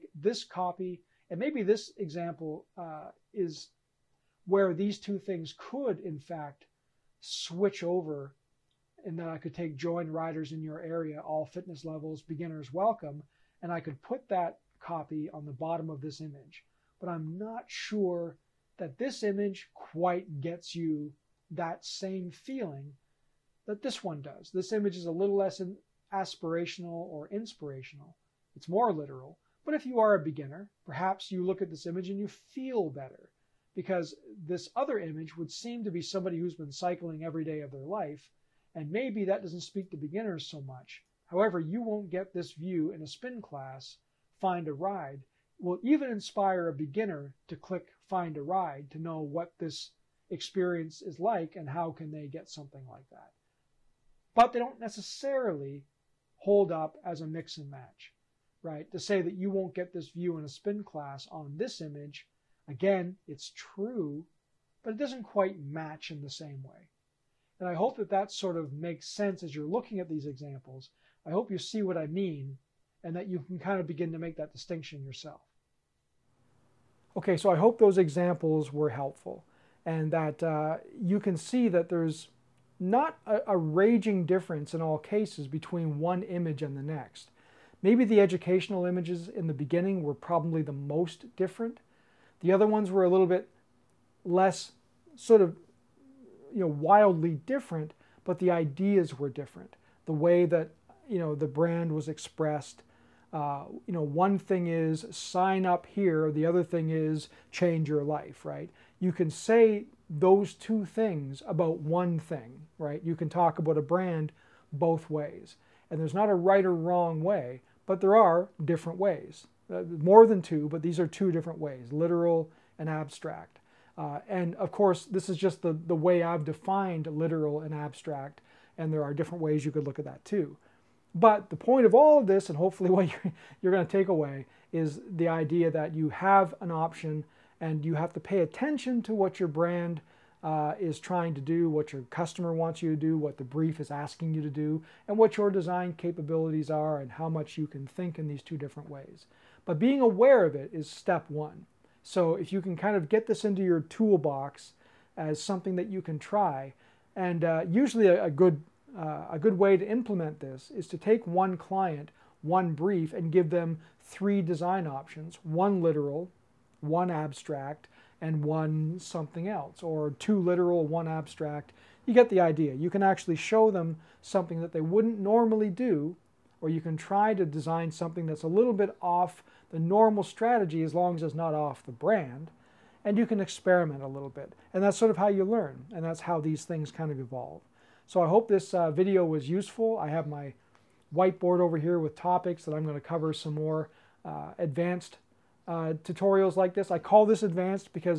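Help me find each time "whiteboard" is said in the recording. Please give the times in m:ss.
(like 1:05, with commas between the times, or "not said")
3:11.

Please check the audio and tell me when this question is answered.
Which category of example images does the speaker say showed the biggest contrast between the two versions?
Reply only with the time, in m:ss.
1:28.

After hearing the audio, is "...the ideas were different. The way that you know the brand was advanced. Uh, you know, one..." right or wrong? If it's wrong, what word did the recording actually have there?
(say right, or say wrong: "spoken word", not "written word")
wrong: "expressed", not "advanced".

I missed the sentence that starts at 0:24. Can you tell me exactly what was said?
This image is a little less aspirational or inspirational, it's more literal.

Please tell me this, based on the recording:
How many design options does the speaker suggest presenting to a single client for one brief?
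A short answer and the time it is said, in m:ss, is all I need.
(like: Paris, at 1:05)
3, at 2:44.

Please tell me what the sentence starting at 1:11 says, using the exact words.
I hope you see what I mean and that you can kind of begin to make that distinction yourself.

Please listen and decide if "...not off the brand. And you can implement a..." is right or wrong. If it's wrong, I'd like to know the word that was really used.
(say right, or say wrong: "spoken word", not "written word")
wrong: "experiment", not "implement".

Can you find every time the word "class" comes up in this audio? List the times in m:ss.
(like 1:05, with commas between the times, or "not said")
0:43, 1:00.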